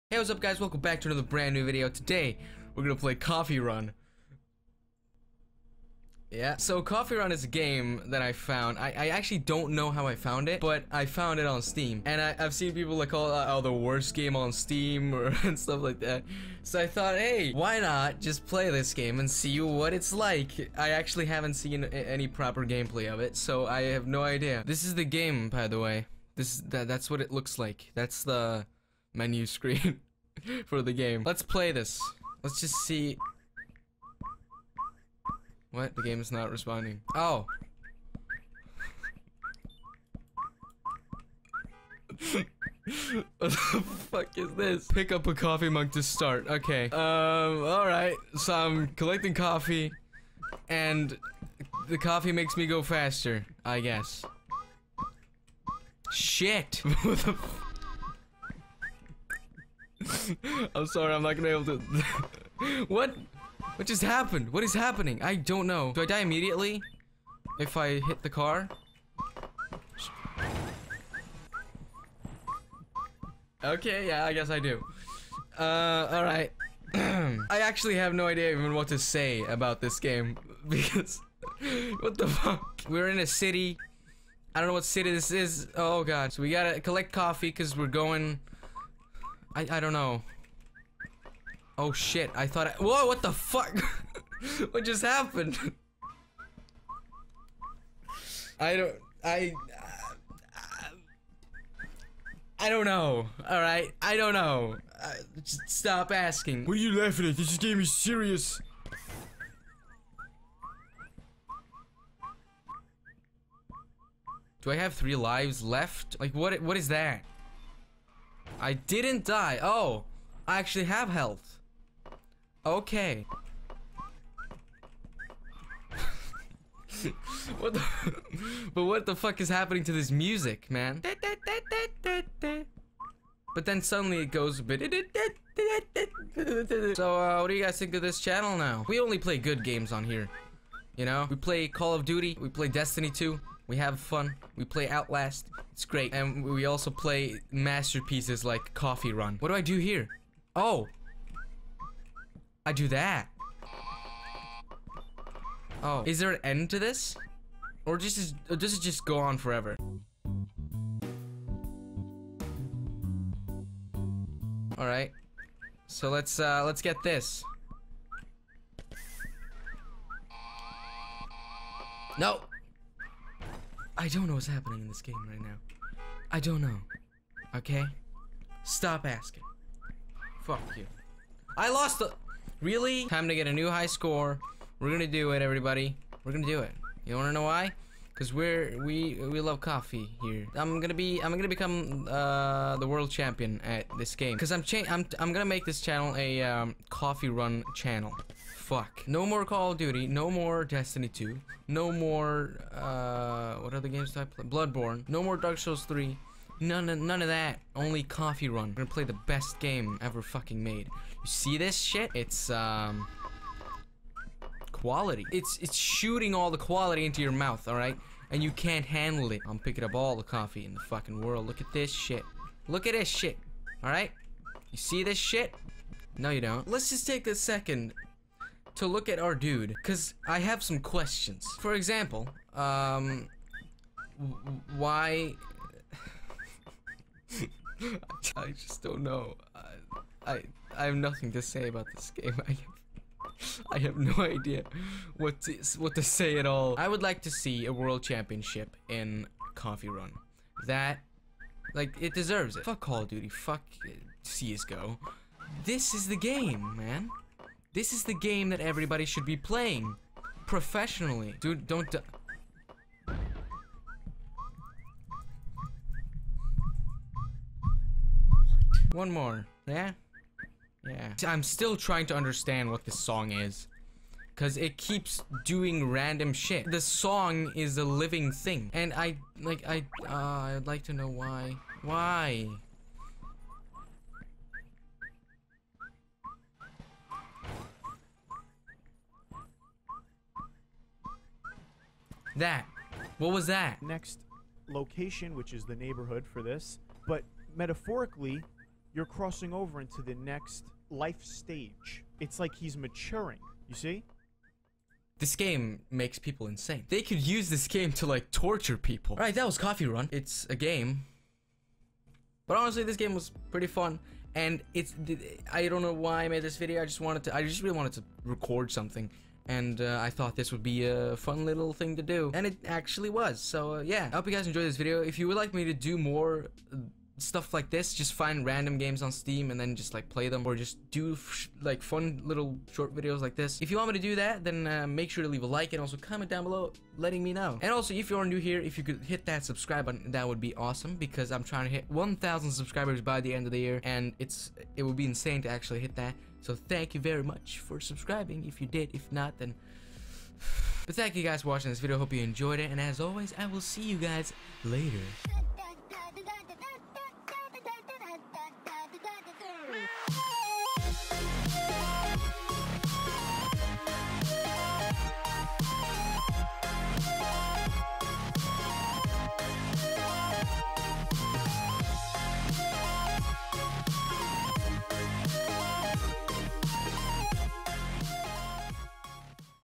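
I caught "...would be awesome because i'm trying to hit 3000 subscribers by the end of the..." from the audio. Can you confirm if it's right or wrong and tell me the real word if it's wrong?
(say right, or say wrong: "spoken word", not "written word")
wrong: "1000", not "3000".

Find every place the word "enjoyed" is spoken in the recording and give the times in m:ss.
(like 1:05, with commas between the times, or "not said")
5:24, 5:52.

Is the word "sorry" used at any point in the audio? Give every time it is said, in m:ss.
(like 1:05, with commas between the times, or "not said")
1:00.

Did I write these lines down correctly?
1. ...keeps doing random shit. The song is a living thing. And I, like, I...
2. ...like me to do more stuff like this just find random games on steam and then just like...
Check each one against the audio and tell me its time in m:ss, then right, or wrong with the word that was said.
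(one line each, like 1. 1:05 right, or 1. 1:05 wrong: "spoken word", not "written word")
1. 4:34 right
2. 5:25 right.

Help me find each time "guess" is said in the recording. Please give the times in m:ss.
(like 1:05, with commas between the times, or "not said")
0:53, 1:14.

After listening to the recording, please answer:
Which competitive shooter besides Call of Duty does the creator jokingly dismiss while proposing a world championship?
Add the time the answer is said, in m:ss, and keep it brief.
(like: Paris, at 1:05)
CS:GO, at 4:14.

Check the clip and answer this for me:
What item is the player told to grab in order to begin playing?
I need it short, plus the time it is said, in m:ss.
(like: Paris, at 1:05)
A coffee mug, at 0:45.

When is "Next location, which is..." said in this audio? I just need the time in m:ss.
4:53.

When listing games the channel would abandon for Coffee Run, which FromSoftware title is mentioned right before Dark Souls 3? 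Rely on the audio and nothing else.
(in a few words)
Bloodborne.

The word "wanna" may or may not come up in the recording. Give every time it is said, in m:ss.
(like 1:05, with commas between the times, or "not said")
3:07.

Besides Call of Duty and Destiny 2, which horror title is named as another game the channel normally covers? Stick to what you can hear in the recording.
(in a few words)
Outlast.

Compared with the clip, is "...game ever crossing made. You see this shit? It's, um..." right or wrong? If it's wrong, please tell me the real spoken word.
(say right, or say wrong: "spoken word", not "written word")
wrong: "fucking", not "crossing".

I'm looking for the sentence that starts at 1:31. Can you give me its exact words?
Oh shit, I thought I- Whoa, what the fuck?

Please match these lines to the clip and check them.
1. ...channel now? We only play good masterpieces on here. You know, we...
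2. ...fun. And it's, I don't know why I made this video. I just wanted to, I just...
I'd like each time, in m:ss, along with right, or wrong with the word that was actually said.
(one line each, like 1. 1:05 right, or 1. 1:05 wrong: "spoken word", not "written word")
1. 2:18 wrong: "games", not "masterpieces"
2. 5:13 right.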